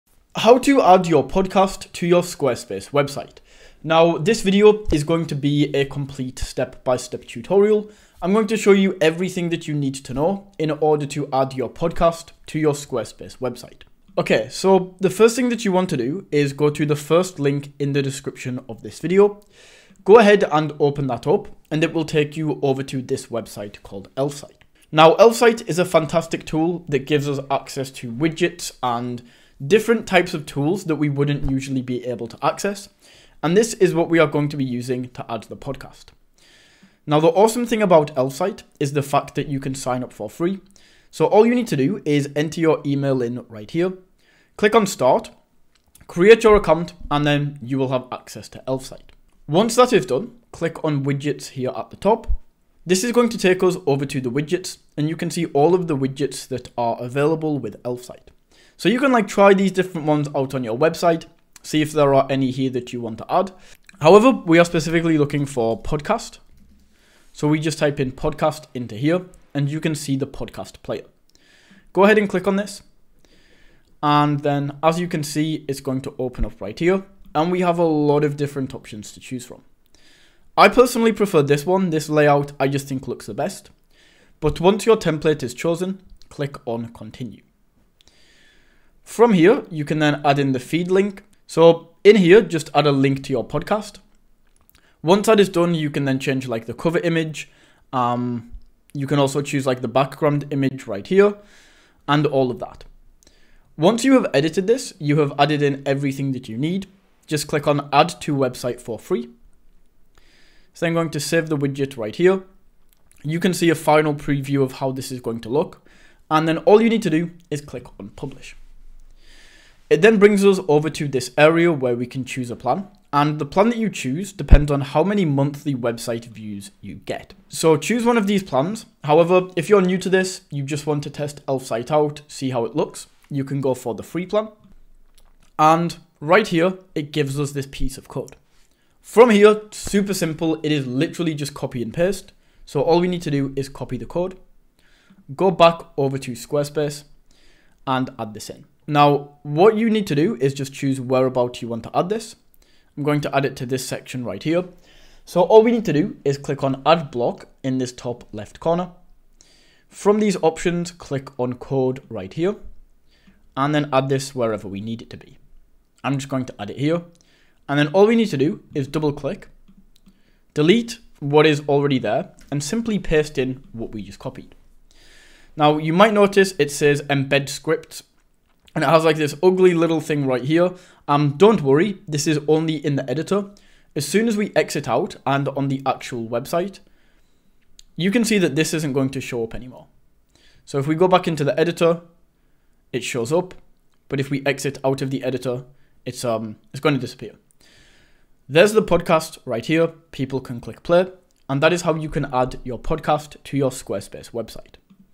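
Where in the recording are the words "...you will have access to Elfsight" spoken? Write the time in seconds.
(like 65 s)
47 s.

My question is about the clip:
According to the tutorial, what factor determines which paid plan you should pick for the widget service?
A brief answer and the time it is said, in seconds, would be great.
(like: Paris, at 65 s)
monthly website views, at 125 s.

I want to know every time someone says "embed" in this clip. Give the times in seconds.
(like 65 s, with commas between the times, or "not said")
177 s.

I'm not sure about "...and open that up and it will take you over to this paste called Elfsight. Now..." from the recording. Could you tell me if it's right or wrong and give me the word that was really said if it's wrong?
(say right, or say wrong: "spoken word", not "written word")
wrong: "website", not "paste".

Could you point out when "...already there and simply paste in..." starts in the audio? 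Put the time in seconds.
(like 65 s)
171 s.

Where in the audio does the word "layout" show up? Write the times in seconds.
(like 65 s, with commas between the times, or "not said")
82 s.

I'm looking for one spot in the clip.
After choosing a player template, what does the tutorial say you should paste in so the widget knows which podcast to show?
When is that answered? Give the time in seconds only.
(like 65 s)
90 s.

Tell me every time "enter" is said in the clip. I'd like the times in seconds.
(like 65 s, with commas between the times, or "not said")
42 s.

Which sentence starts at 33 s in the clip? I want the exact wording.
And this is what we are going to be using to add to the podcast.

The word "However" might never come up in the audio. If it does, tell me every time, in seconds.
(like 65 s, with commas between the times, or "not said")
64 s, 129 s.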